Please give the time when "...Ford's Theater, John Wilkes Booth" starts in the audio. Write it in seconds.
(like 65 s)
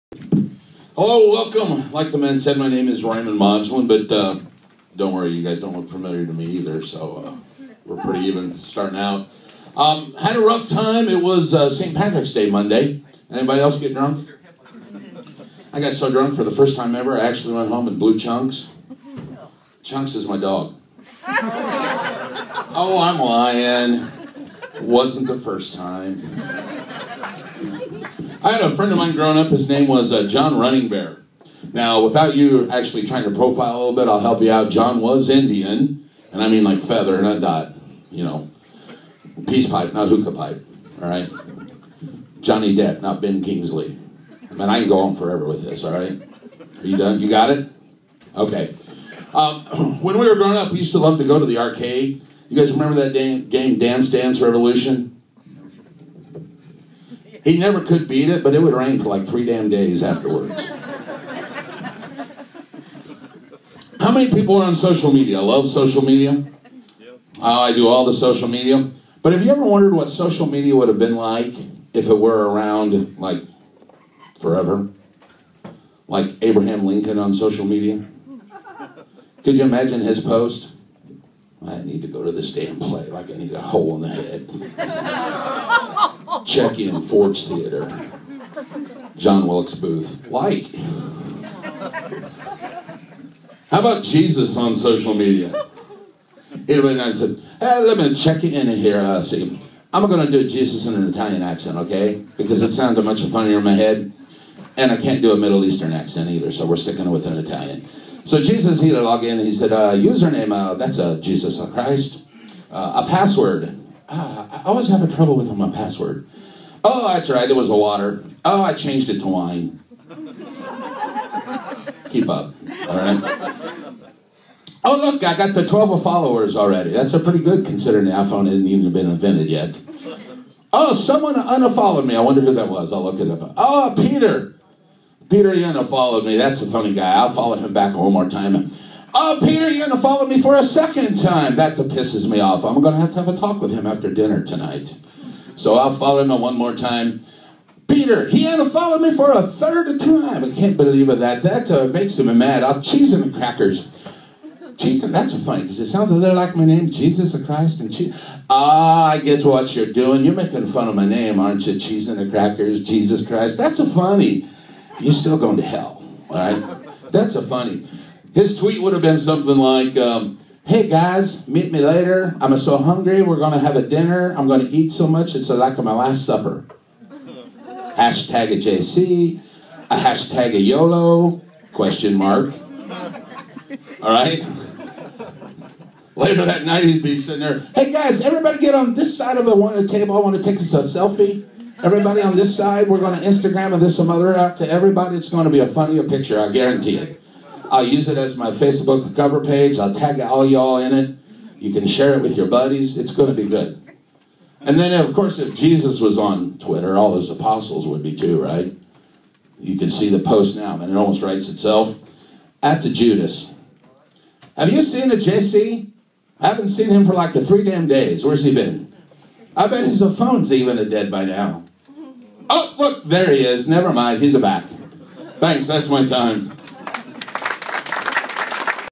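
87 s.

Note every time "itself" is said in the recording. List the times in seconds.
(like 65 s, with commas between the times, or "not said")
211 s.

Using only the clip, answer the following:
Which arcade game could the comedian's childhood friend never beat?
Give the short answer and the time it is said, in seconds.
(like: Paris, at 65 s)
Dance Dance Revolution, at 53 s.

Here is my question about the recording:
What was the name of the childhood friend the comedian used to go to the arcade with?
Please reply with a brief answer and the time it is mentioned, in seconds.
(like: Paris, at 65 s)
John Running Bear, at 30 s.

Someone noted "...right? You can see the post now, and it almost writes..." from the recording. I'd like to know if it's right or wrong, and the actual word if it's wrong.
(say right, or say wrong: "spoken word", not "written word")
right.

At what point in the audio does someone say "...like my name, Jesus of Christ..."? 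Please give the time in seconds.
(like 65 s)
156 s.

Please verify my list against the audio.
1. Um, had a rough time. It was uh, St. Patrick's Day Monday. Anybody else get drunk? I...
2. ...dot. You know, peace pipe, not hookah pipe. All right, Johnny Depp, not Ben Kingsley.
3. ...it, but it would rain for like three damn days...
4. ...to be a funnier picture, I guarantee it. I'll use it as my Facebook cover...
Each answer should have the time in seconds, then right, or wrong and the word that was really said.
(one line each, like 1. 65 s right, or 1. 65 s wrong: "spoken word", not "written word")
1. 9 s right
2. 37 s right
3. 58 s right
4. 195 s right.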